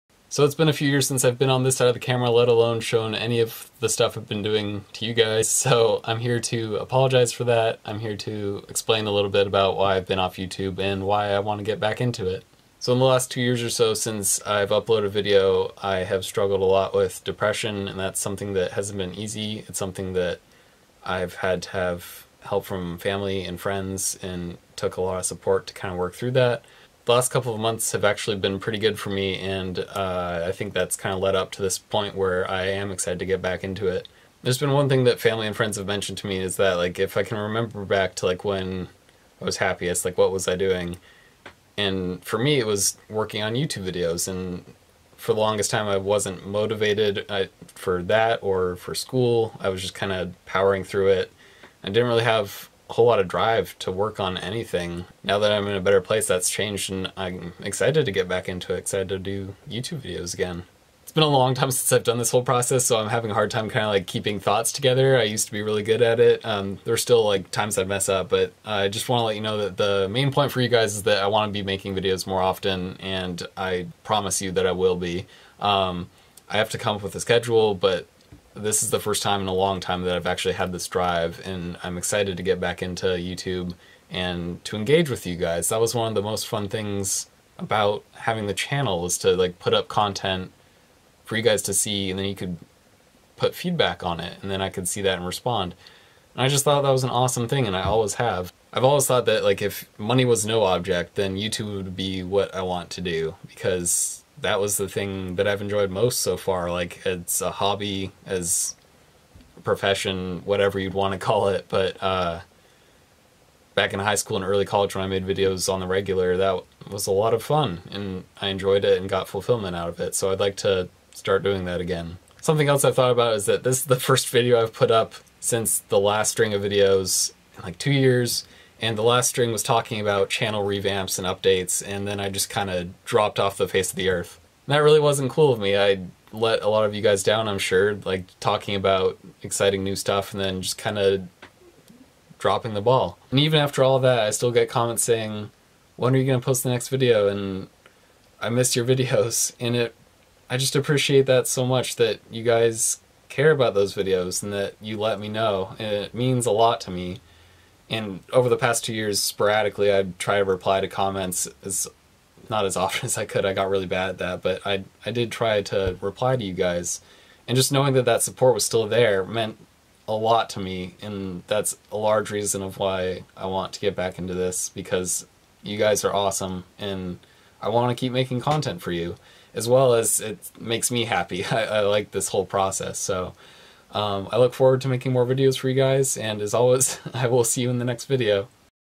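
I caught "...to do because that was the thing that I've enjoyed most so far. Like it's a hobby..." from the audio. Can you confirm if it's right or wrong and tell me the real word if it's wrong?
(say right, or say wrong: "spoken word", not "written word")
right.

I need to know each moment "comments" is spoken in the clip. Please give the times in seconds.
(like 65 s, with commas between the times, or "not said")
144 s, 160 s.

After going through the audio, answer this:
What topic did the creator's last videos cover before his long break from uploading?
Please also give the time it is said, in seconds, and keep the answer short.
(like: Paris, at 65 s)
Channel revamps and updates, at 130 s.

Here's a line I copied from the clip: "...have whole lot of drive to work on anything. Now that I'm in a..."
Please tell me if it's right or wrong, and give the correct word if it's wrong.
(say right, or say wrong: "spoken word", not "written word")
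right.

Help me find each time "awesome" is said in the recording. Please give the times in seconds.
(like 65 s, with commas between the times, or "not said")
97 s, 176 s.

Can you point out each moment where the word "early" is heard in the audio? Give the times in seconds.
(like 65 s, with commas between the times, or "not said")
114 s.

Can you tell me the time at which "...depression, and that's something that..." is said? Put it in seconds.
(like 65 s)
17 s.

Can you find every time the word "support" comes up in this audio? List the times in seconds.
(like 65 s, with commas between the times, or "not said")
25 s, 168 s.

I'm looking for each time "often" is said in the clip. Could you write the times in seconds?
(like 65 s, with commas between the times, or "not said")
72 s, 162 s.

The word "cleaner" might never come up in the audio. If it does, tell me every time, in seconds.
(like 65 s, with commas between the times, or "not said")
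not said.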